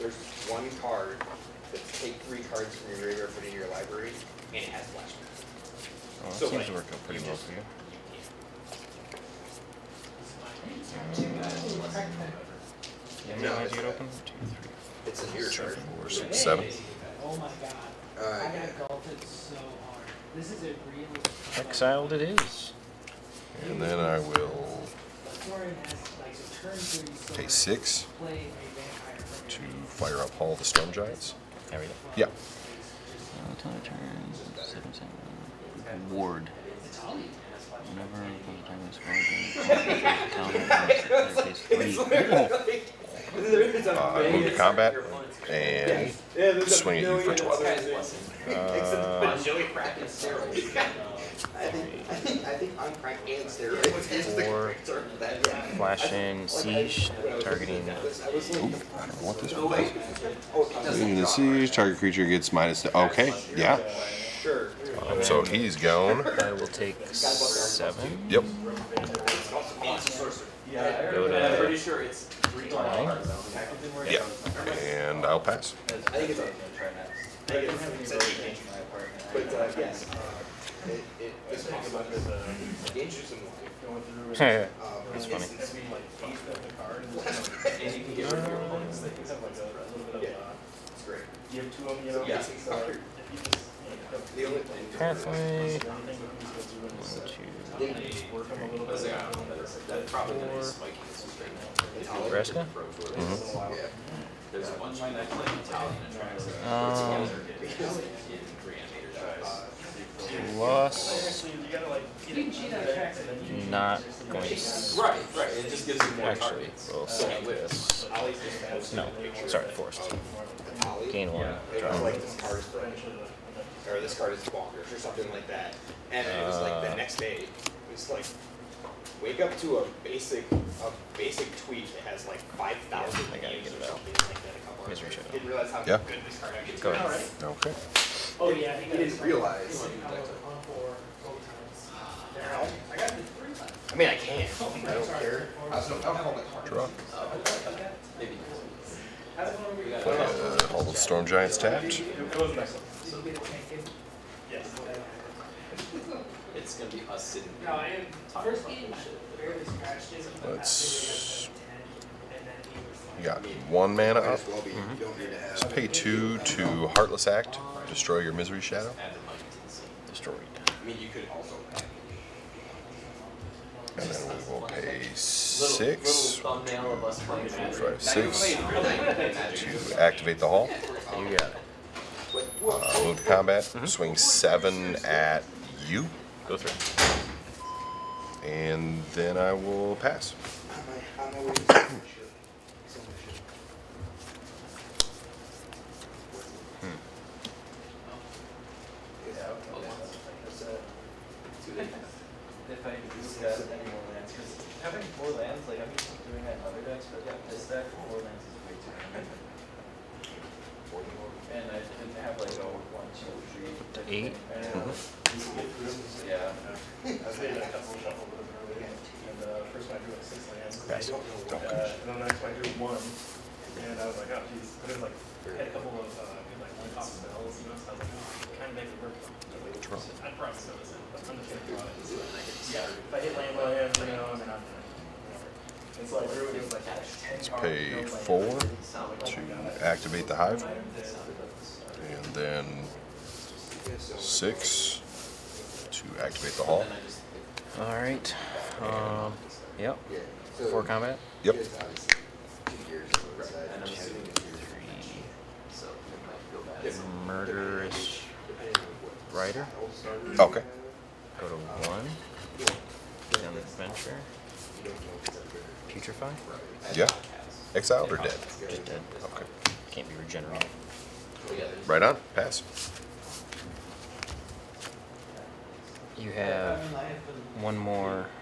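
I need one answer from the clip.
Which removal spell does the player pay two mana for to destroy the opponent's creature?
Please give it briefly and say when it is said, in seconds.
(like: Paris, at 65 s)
Heartless Act, at 166 s.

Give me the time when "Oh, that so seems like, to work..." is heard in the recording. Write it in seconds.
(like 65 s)
6 s.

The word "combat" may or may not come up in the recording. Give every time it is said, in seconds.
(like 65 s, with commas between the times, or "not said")
44 s, 183 s, 250 s.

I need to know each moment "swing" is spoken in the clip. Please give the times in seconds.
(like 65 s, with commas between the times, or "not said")
46 s, 183 s.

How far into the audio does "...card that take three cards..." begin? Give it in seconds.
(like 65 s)
0 s.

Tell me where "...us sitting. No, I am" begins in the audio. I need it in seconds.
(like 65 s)
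157 s.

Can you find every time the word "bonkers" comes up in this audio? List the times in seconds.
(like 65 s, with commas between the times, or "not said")
124 s.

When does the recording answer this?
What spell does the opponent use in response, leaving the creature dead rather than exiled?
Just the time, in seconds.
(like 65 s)
265 s.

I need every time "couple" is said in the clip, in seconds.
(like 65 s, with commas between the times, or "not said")
134 s, 217 s, 225 s.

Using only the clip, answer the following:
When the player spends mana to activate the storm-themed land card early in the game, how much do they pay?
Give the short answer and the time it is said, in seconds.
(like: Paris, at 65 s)
6, at 27 s.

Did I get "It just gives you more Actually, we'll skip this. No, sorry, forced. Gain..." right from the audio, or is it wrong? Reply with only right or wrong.
right.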